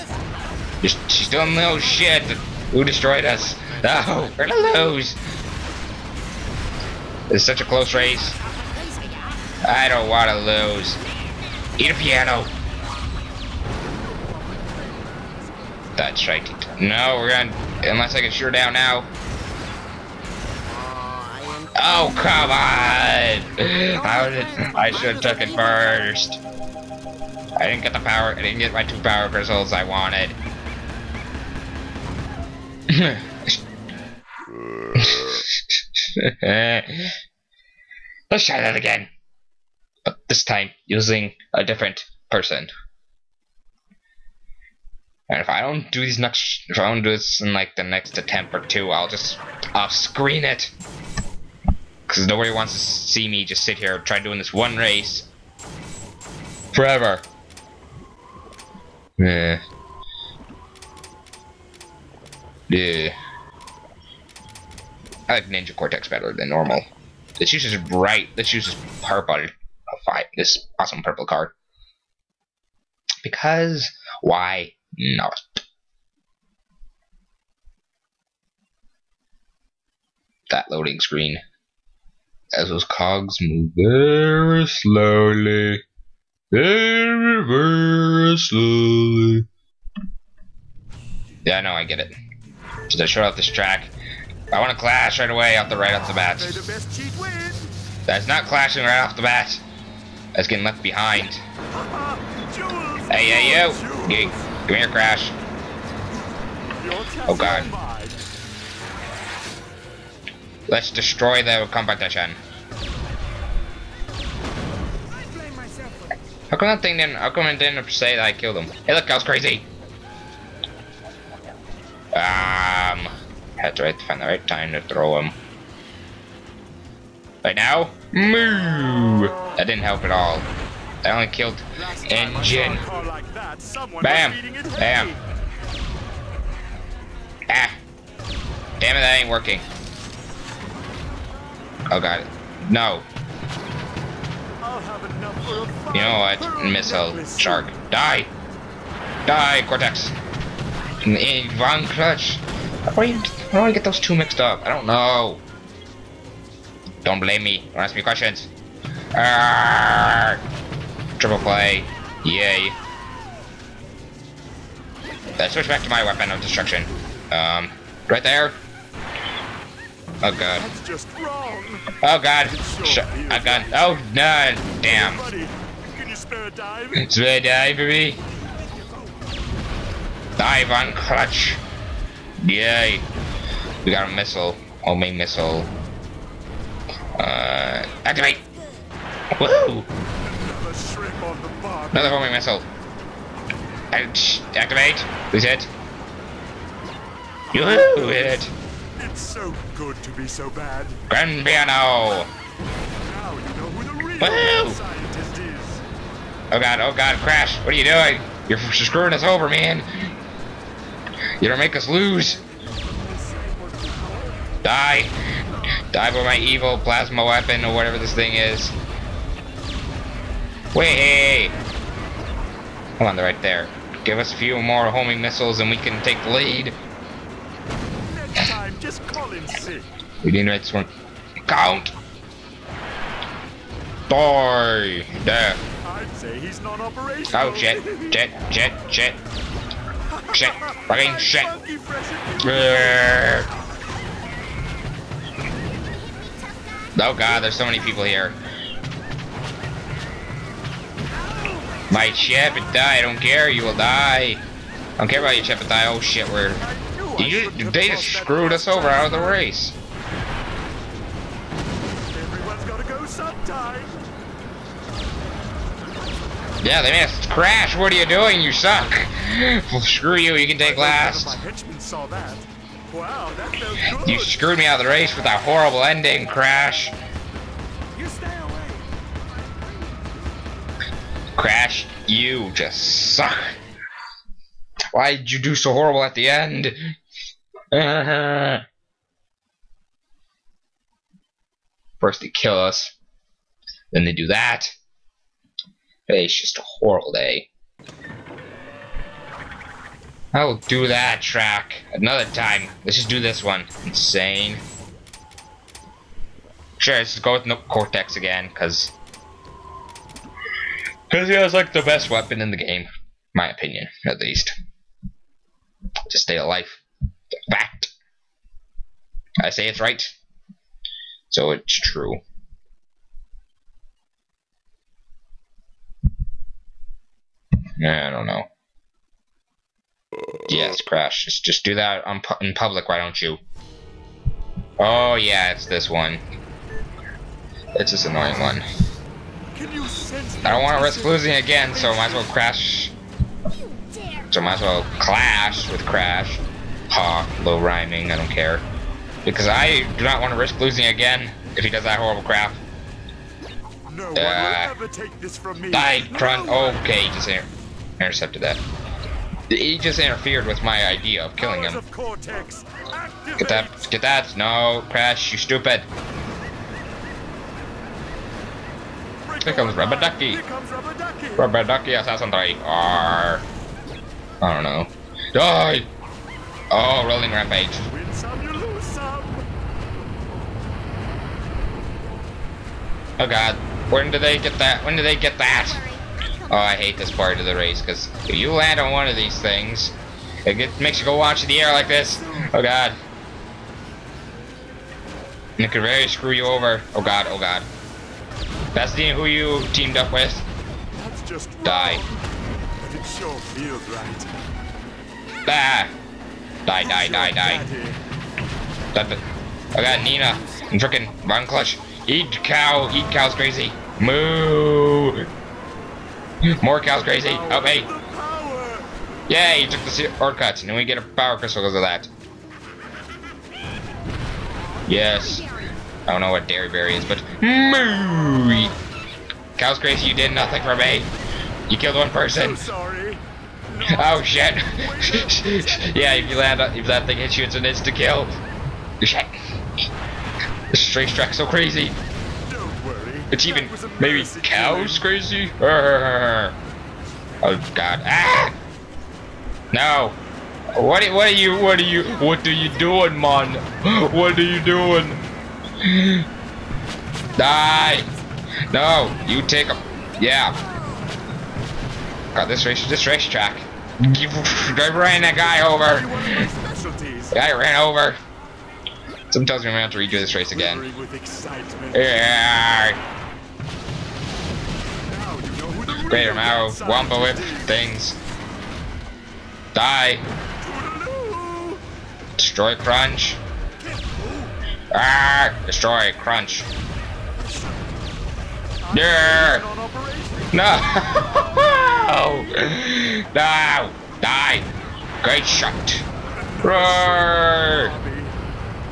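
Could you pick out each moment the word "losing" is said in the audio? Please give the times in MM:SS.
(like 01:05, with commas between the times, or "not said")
05:41, 05:50.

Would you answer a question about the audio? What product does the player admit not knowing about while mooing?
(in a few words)
Dairy Berry.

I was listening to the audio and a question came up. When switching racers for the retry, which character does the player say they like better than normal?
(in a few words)
Nina Cortex.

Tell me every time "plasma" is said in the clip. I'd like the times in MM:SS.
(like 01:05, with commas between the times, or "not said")
03:36.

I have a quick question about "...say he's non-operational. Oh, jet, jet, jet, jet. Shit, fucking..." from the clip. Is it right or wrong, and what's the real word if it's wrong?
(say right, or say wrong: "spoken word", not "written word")
right.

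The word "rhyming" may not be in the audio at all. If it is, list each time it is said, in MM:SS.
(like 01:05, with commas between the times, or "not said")
05:47.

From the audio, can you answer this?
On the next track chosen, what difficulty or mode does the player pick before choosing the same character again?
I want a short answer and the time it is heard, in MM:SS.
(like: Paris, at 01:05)
Insane, at 05:03.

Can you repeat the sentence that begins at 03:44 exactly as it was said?
Give us a few more homing missiles and we can take the lead just call sick.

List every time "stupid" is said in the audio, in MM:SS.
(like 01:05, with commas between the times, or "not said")
06:05.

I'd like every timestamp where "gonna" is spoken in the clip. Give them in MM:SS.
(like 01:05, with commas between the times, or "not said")
00:04, 00:17, 07:49.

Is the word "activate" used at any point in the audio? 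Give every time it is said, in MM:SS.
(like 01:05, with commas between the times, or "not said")
03:08, 03:14.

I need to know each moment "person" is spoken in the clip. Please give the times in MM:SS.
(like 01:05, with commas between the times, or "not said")
00:42, 07:12.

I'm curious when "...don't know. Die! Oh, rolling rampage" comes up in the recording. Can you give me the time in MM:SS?
06:14.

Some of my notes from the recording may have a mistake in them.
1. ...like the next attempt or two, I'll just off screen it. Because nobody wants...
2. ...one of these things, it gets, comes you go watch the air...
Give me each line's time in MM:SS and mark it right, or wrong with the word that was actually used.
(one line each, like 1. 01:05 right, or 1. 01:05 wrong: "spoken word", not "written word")
1. 00:47 right
2. 06:28 wrong: "makes", not "comes".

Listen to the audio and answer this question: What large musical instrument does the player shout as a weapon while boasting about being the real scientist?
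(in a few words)
Grand Piano.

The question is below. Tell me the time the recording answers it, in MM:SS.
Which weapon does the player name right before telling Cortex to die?
02:26.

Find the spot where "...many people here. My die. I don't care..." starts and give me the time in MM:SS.
04:07.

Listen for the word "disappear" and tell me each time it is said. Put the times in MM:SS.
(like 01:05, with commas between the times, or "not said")
not said.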